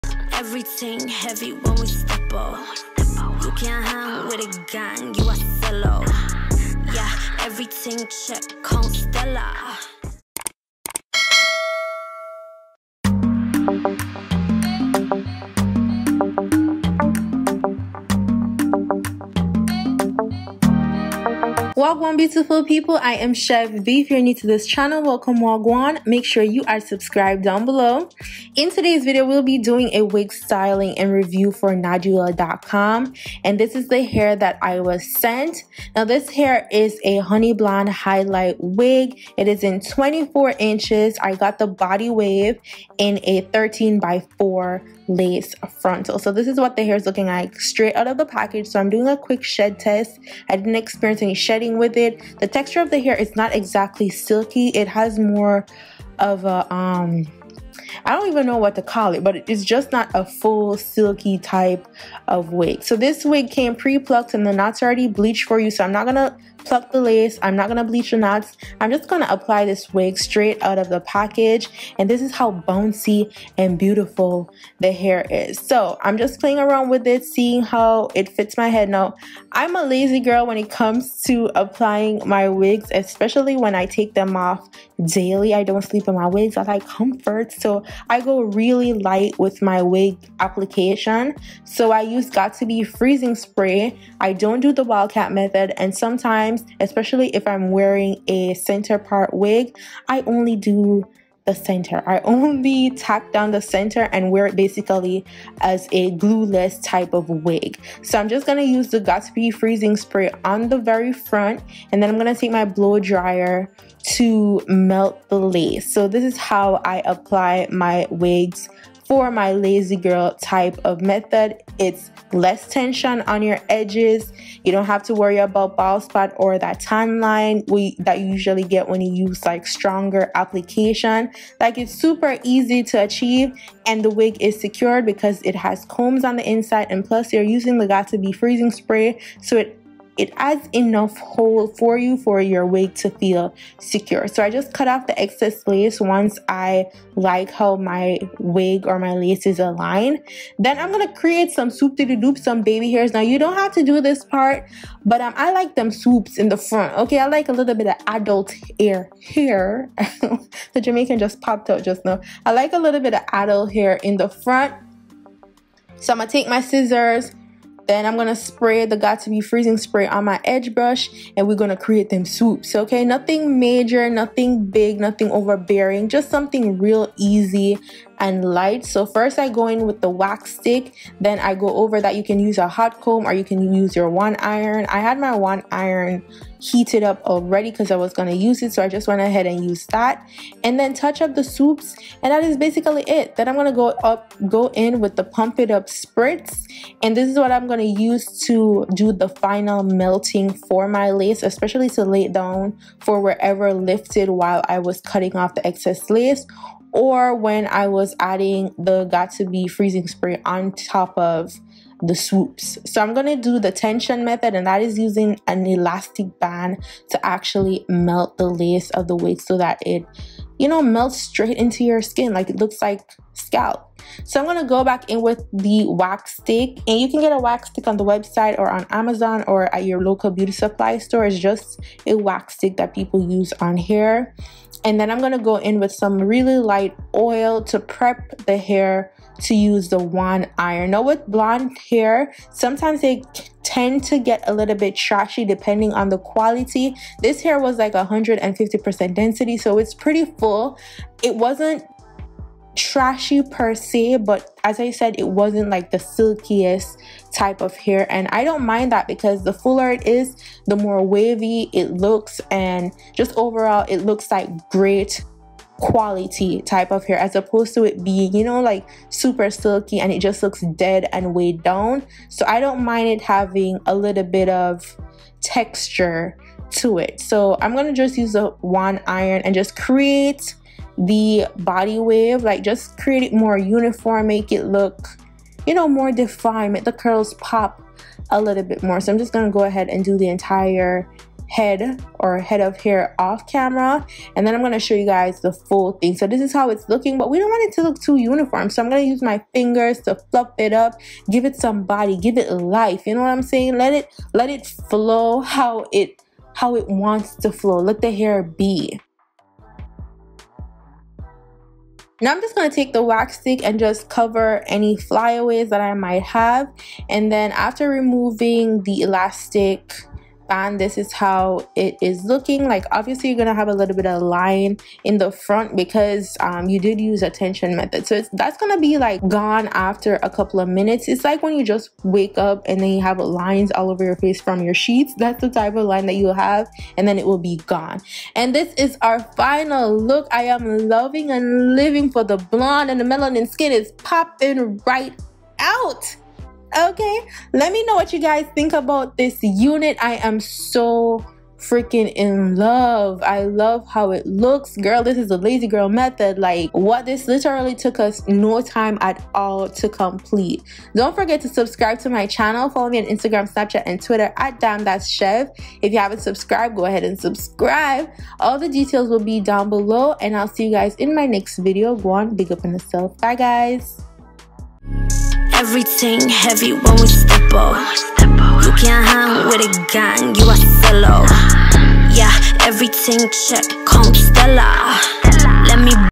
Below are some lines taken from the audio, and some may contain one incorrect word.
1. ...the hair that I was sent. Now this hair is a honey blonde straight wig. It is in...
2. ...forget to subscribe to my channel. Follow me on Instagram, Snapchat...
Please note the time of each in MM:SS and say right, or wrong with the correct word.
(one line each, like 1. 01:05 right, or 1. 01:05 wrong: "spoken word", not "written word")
1. 00:33 wrong: "highlight", not "straight"
2. 06:01 right.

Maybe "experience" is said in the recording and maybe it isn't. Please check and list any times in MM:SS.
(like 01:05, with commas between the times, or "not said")
00:50.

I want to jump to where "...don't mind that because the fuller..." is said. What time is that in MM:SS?
04:18.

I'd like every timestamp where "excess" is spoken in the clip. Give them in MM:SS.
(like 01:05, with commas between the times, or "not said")
02:25, 03:25.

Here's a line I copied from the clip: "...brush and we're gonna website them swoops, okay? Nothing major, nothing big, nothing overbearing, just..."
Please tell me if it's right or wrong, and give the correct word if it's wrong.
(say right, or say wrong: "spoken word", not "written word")
wrong: "create", not "website".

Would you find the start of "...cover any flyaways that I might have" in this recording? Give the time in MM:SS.
05:14.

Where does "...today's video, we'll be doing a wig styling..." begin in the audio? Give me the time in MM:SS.
00:28.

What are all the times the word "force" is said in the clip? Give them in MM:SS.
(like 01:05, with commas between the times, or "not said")
not said.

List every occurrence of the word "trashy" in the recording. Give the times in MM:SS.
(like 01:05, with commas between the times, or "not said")
04:04, 04:12.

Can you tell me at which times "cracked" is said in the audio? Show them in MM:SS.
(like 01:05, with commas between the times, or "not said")
not said.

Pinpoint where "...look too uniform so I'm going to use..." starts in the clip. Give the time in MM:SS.
04:57.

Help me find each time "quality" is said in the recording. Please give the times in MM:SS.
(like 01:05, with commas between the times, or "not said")
04:06, 04:25.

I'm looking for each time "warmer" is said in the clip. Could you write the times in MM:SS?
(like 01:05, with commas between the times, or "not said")
not said.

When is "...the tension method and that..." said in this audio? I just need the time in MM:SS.
03:33.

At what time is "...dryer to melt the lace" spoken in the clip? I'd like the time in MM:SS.
01:52.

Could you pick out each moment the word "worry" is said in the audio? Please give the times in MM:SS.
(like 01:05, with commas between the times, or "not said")
02:05.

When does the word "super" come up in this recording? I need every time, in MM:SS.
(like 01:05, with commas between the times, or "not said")
02:11, 04:29.